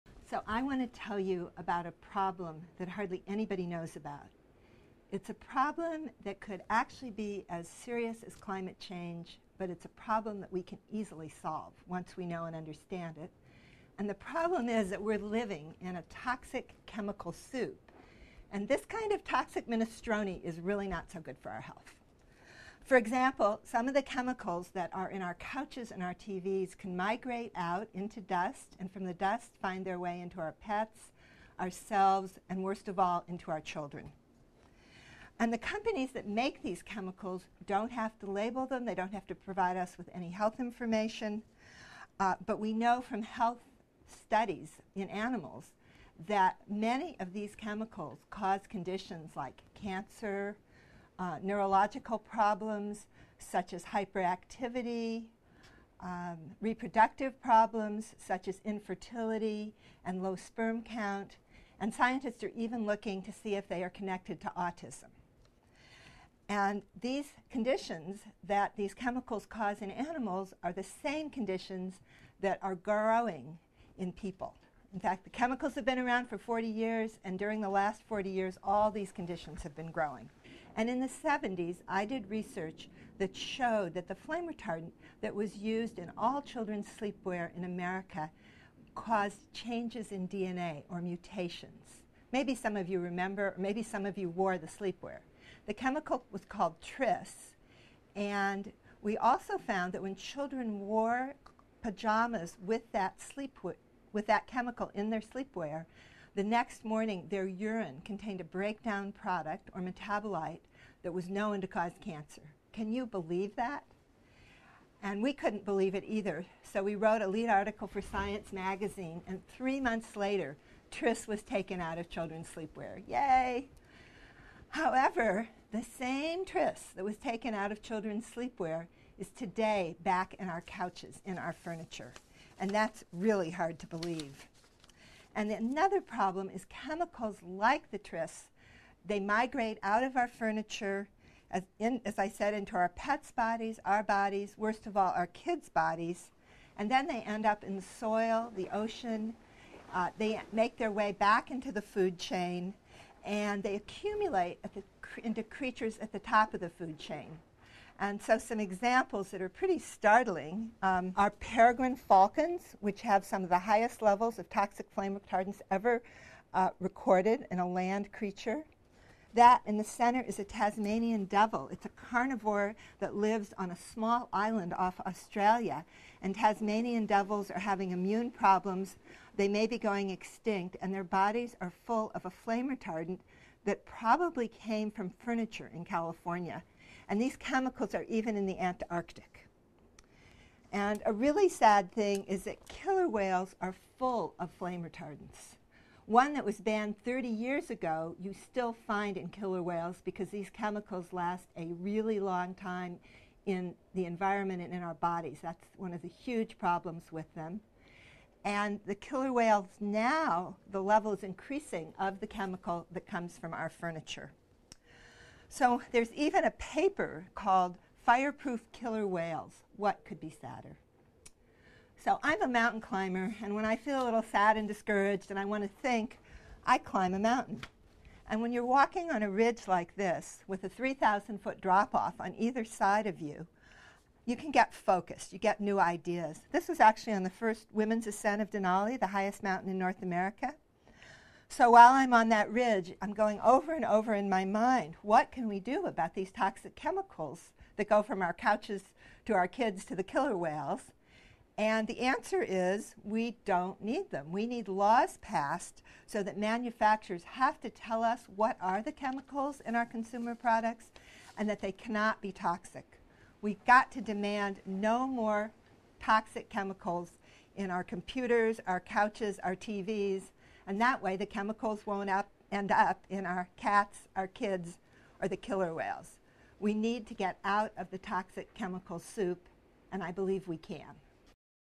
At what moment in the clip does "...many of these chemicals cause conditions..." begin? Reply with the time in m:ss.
0:46.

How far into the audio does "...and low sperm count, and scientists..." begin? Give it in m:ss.
1:00.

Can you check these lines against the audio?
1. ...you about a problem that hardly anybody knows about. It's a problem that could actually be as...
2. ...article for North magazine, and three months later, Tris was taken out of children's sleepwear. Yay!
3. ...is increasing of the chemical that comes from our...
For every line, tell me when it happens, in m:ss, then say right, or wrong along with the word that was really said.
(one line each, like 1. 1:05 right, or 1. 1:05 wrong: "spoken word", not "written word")
1. 0:01 right
2. 1:57 wrong: "Science", not "North"
3. 3:31 right.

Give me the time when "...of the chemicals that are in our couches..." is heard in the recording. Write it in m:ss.
0:23.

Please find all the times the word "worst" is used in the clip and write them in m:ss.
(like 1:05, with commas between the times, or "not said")
0:32, 2:24.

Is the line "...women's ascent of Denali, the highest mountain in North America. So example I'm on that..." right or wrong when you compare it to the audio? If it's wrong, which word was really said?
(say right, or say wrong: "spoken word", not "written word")
wrong: "while", not "example".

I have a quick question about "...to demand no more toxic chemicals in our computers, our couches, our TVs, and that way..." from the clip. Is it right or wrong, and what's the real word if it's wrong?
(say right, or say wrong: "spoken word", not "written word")
right.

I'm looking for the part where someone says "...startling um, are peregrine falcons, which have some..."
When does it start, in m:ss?
2:39.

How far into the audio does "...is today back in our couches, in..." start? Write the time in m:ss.
2:09.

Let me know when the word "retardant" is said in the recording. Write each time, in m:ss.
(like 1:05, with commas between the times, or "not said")
1:24, 2:45, 3:02, 3:14.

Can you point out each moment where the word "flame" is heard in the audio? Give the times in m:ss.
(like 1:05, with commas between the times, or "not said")
1:24, 2:44, 3:02, 3:14.